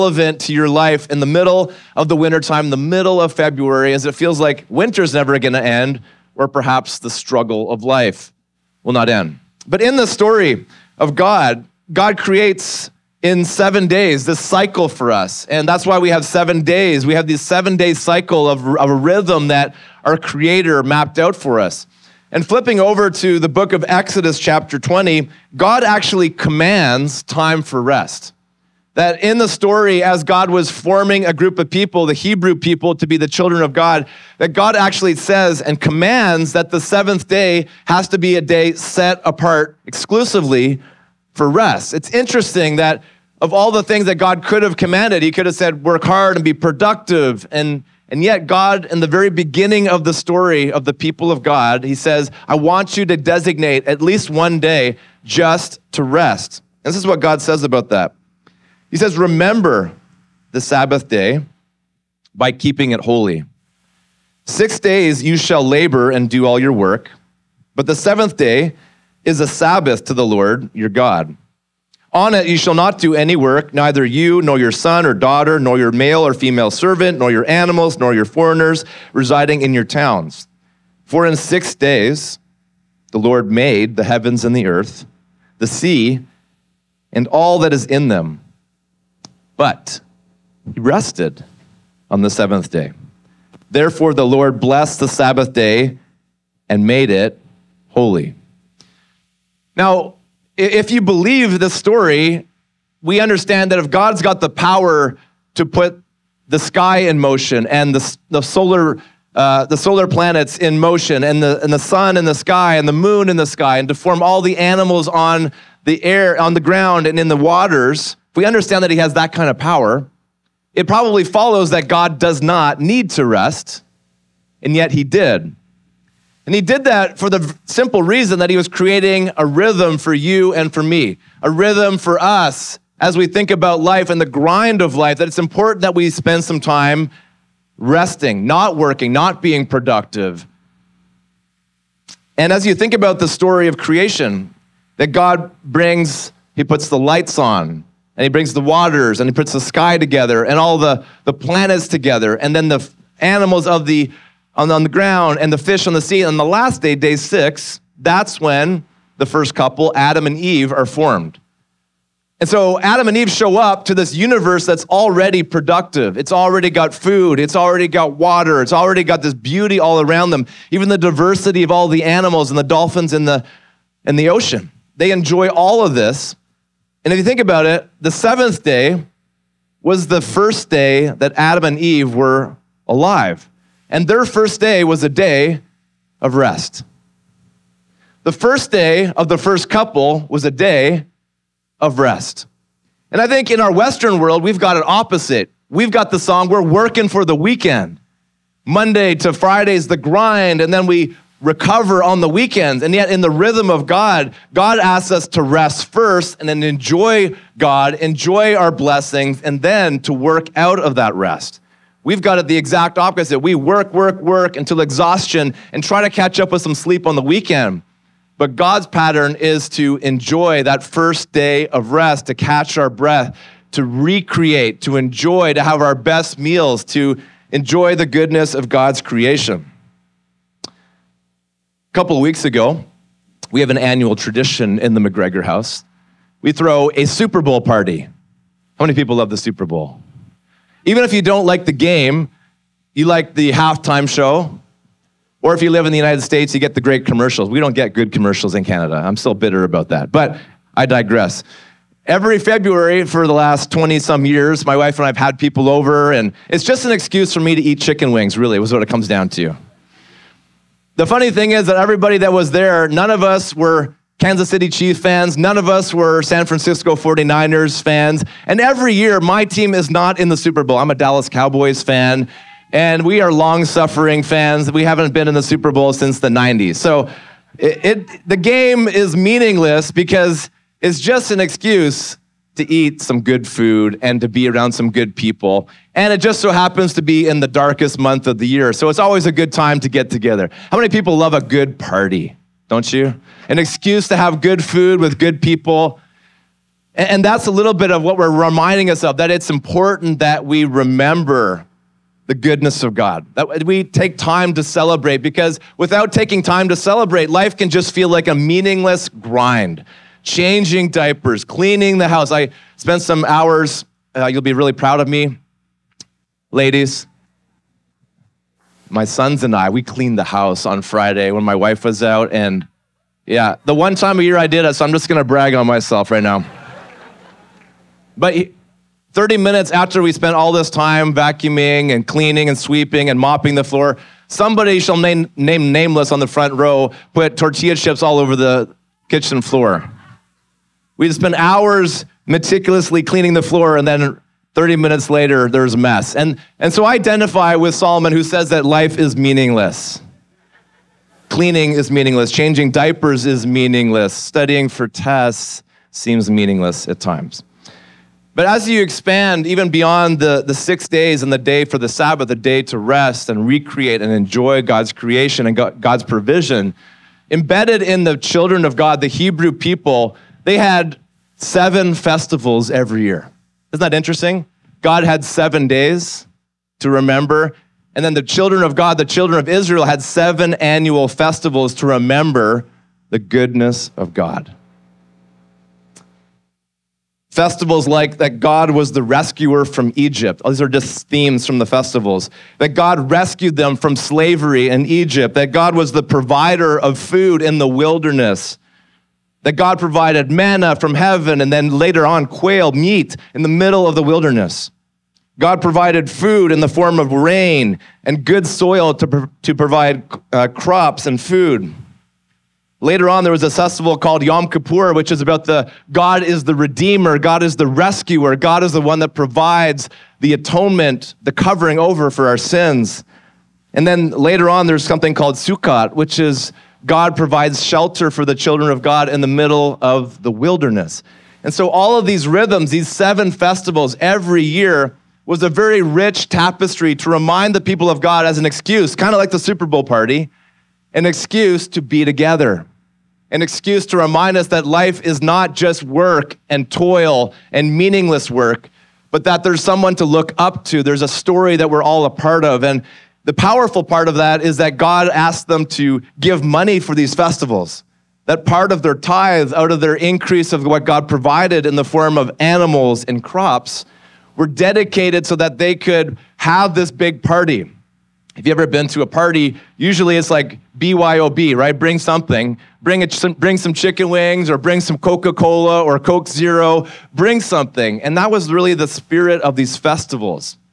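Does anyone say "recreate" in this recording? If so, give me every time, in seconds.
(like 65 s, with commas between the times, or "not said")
223 s, 363 s.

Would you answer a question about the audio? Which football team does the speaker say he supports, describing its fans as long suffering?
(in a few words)
Dallas Cowboys.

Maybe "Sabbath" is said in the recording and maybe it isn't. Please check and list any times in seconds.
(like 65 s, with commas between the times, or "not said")
60 s, 69 s, 95 s, 361 s.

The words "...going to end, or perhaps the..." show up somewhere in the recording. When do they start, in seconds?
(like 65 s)
5 s.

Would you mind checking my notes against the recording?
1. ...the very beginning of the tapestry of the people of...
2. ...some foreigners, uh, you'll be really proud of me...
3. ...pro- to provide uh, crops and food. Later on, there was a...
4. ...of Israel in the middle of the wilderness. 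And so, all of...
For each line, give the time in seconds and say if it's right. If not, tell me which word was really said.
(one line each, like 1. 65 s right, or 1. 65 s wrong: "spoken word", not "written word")
1. 49 s wrong: "story", not "tapestry"
2. 313 s wrong: "hours", not "foreigners"
3. 409 s right
4. 428 s wrong: "God", not "Israel".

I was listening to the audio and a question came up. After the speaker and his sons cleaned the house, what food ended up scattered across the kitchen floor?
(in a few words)
Tortilla chips.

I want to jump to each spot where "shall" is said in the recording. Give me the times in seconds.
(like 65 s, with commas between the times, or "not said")
65 s, 72 s, 334 s.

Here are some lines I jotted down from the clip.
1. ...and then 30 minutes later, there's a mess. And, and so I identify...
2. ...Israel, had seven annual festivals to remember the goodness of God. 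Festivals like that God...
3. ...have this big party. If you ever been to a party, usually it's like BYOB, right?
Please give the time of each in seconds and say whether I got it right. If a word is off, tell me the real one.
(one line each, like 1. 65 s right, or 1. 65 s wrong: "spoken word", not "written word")
1. 343 s right
2. 379 s right
3. 466 s right.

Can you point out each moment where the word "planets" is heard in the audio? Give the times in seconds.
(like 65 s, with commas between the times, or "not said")
110 s, 151 s.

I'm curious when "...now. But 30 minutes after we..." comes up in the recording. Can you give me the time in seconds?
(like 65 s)
326 s.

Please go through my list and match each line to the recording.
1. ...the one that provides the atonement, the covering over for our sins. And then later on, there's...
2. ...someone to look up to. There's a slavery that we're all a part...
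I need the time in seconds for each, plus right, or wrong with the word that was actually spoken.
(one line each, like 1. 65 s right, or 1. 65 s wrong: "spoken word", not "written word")
1. 418 s right
2. 449 s wrong: "story", not "slavery".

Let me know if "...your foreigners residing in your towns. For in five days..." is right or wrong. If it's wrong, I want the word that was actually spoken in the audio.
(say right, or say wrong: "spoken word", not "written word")
wrong: "six", not "five".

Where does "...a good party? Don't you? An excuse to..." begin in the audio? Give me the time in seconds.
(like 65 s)
291 s.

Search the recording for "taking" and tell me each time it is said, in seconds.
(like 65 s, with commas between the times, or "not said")
306 s.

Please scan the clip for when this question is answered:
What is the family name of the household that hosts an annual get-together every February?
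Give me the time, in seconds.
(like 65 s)
235 s.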